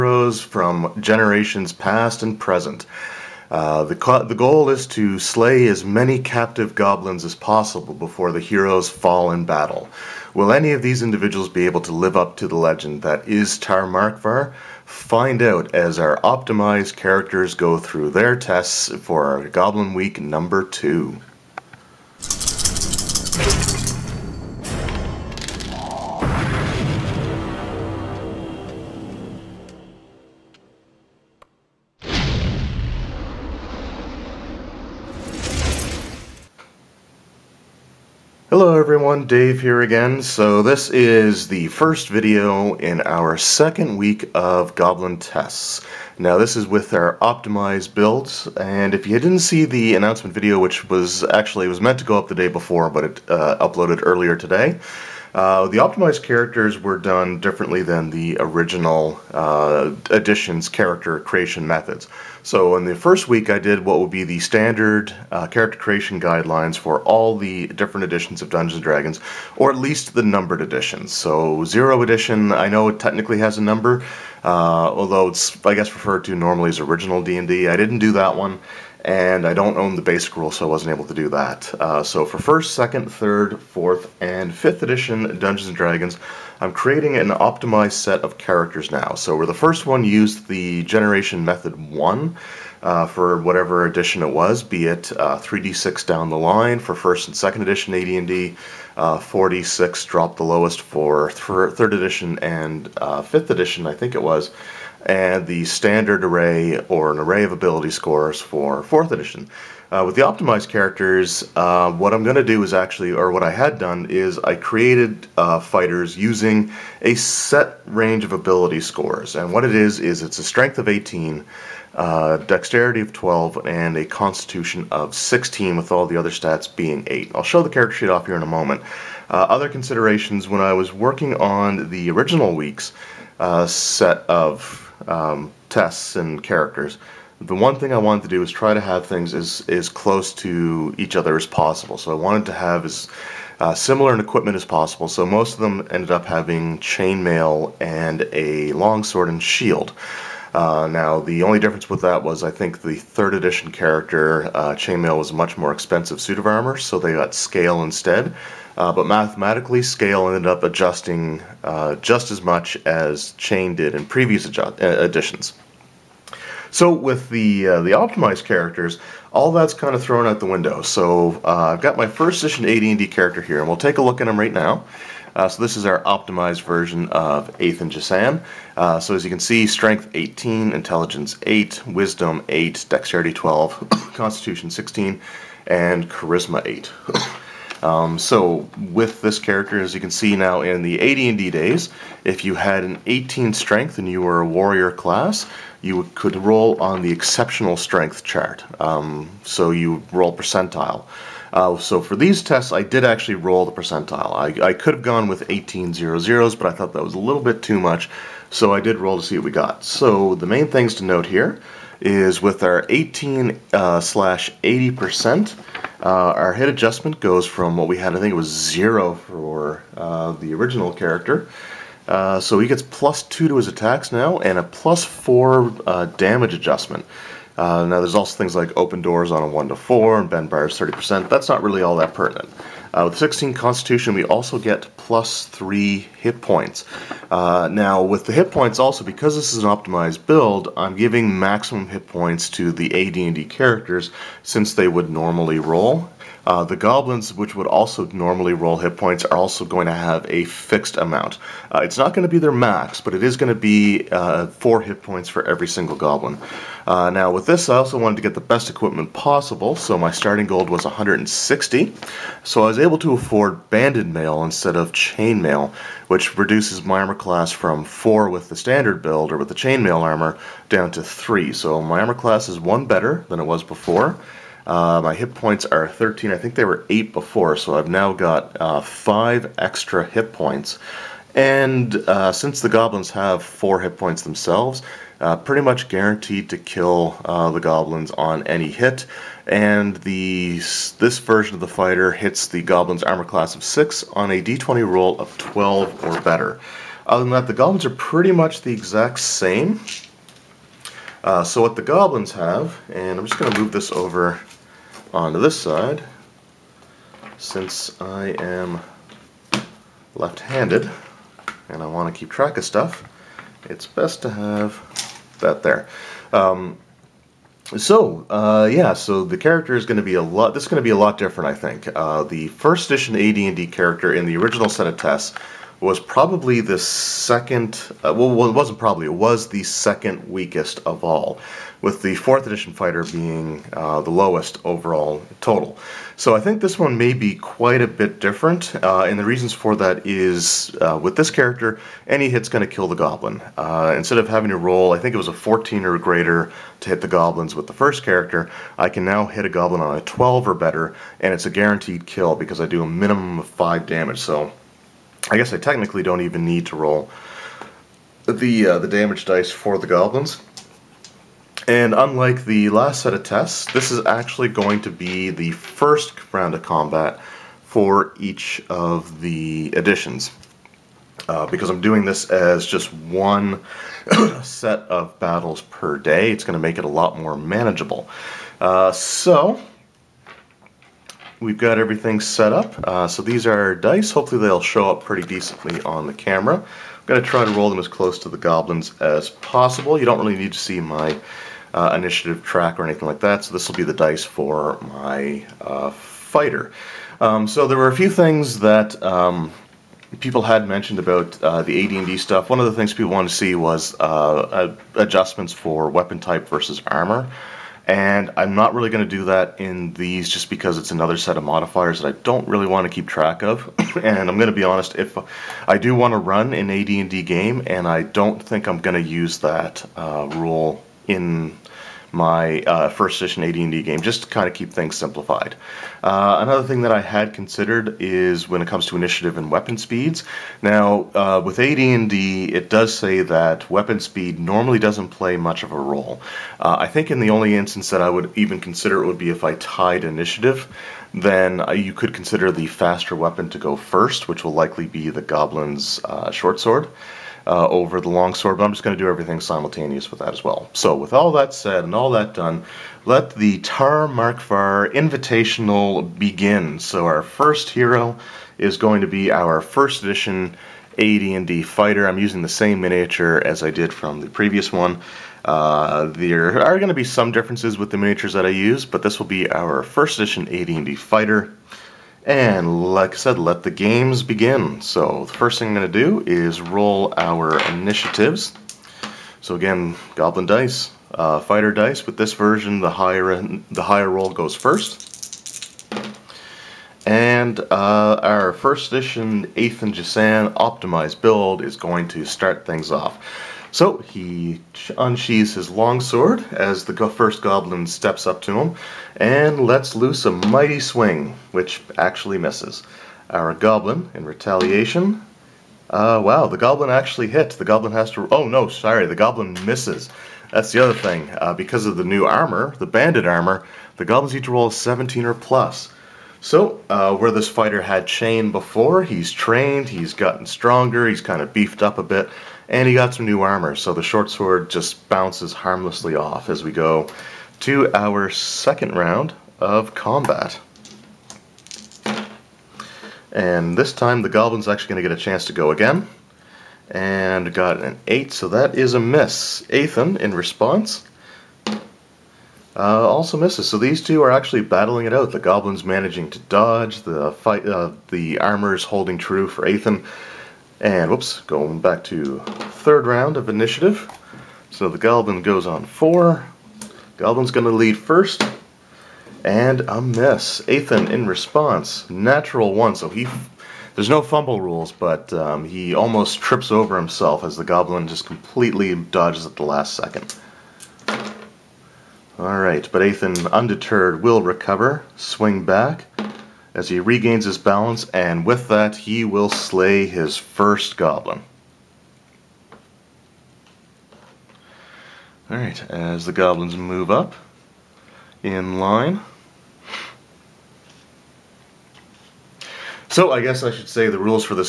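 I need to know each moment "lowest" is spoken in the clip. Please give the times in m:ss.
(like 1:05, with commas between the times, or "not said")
1:40, 5:34.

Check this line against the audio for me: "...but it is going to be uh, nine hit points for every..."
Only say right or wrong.
wrong.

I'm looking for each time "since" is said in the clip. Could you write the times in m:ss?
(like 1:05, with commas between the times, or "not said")
4:04, 4:42, 5:07.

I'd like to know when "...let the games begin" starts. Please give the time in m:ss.
7:53.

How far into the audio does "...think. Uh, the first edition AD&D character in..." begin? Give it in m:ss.
5:21.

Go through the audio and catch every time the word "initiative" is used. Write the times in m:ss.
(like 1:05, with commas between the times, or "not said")
6:31, 7:08, 7:20, 7:57, 9:13.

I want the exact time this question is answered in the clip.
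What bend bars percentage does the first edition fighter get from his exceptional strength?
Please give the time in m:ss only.
3:50.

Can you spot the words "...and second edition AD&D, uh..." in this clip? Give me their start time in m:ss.
1:37.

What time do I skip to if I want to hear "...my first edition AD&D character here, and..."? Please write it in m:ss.
2:51.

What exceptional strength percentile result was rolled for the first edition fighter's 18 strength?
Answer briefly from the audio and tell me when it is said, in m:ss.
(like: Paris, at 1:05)
80 percent, at 3:34.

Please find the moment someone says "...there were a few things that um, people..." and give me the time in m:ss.
6:37.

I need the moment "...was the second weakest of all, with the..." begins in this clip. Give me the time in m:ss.
5:29.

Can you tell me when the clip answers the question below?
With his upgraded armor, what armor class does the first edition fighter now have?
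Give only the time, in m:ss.
4:30.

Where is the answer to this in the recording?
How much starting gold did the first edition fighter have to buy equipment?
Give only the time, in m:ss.
4:20.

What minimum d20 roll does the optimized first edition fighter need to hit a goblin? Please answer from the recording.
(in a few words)
12.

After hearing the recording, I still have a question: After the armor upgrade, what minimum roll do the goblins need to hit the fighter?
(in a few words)
17.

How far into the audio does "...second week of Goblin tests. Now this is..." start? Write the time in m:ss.
0:43.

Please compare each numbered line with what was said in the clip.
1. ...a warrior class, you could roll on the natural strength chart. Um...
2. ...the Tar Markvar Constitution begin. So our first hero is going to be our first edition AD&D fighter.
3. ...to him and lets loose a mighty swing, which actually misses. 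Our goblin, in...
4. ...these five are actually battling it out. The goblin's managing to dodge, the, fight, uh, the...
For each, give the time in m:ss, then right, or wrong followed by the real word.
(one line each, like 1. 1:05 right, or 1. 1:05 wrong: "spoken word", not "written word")
1. 3:14 wrong: "exceptional", not "natural"
2. 7:33 wrong: "Invitational", not "Constitution"
3. 8:18 right
4. 9:03 wrong: "two", not "five".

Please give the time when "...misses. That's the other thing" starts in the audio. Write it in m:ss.
8:29.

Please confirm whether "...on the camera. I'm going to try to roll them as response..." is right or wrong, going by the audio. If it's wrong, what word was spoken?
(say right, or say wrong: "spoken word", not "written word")
wrong: "close", not "response".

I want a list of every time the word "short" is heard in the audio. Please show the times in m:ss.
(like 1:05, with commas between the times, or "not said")
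7:26, 8:44.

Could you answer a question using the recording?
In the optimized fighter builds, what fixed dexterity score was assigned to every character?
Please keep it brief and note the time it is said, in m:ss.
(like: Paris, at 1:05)
12, at 2:02.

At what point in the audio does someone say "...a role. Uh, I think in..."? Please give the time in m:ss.
7:15.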